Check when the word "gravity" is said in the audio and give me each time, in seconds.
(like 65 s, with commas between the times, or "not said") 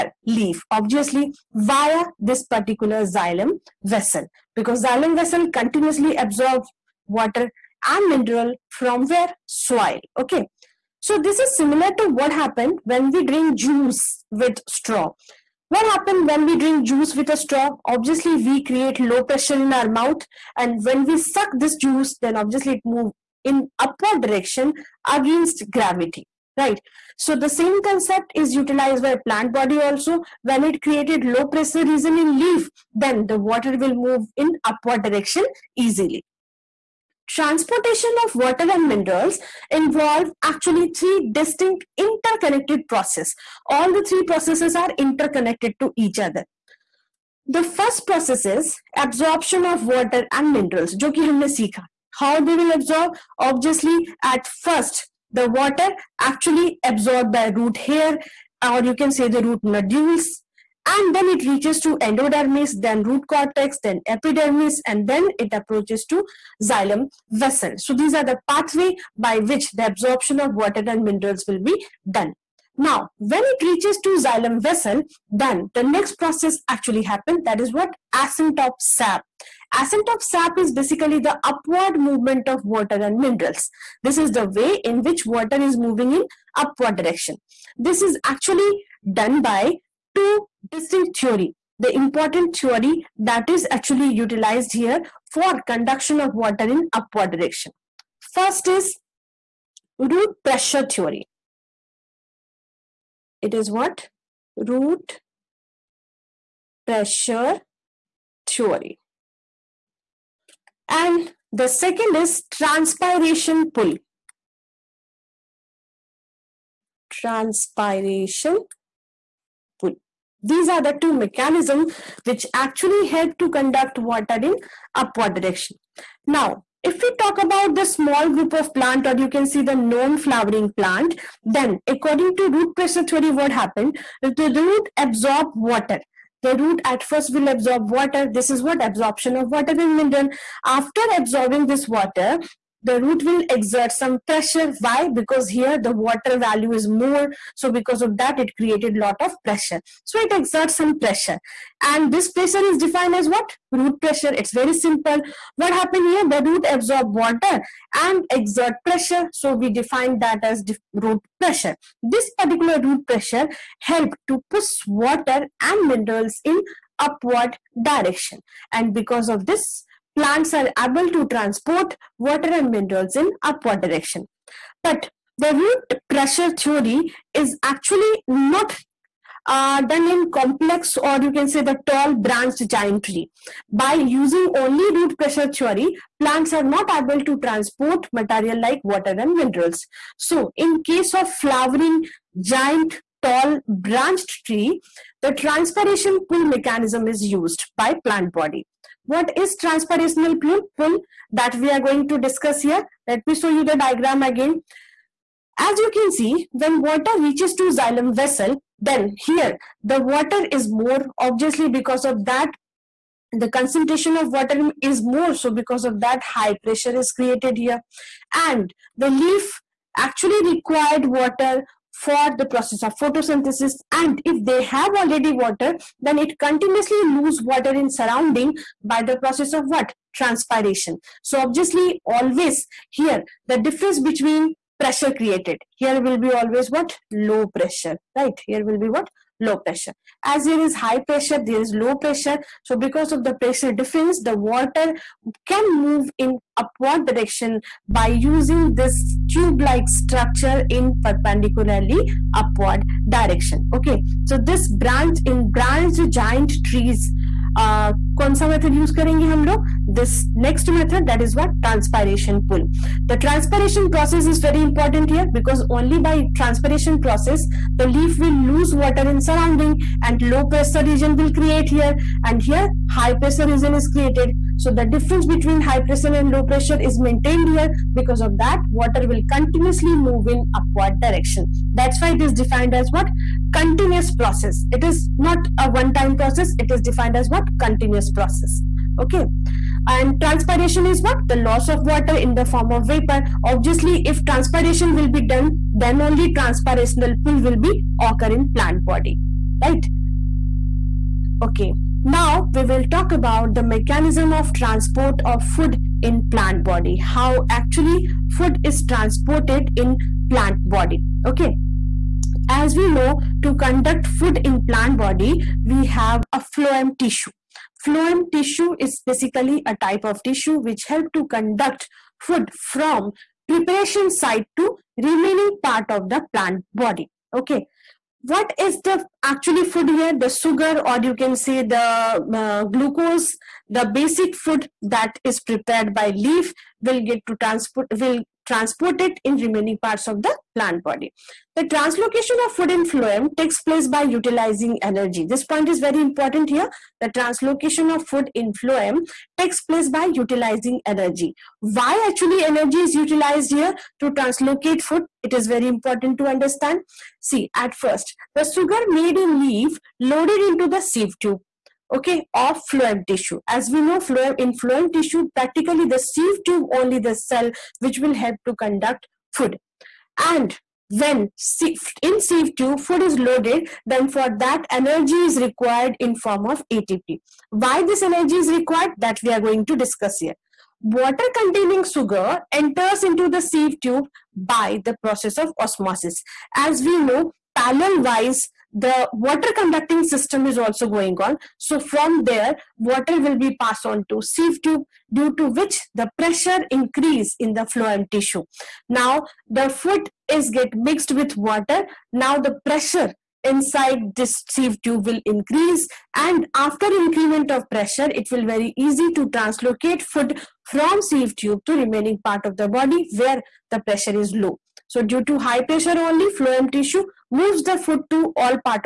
25 s.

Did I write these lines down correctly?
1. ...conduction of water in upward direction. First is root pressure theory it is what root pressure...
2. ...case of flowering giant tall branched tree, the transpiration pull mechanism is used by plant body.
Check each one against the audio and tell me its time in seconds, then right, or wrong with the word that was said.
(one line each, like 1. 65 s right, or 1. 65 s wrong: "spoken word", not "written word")
1. 95 s right
2. 190 s right.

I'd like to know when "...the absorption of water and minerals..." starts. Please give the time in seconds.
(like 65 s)
69 s.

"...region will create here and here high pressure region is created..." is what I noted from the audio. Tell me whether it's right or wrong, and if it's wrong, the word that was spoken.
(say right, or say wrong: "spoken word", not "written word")
right.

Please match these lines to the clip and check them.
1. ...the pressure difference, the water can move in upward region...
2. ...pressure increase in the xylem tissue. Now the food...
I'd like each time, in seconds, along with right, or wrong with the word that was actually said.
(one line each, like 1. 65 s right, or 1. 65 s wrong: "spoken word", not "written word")
1. 243 s wrong: "direction", not "region"
2. 396 s wrong: "phloem", not "xylem".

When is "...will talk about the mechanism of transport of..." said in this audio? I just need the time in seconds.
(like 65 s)
302 s.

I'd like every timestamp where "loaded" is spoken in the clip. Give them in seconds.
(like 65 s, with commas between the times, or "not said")
359 s, 373 s.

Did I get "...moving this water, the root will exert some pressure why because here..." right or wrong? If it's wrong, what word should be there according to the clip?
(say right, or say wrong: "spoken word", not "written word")
wrong: "absorbing", not "moving".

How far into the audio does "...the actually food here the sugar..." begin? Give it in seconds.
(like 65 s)
328 s.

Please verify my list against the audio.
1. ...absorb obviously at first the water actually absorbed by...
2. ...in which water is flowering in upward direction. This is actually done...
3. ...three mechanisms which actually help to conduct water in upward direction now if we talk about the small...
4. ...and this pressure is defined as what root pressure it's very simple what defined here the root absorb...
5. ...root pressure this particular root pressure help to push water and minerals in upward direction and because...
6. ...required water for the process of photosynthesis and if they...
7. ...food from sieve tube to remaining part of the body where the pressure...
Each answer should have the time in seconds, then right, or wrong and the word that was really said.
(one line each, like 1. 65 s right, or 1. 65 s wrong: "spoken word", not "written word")
1. 52 s right
2. 84 s wrong: "moving", not "flowering"
3. 121 s wrong: "two", not "three"
4. 151 s wrong: "happened", not "defined"
5. 160 s right
6. 220 s right
7. 410 s right.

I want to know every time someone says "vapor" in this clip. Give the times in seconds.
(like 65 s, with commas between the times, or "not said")
292 s.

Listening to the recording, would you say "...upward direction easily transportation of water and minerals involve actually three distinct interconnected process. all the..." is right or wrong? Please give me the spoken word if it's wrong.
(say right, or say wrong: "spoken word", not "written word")
right.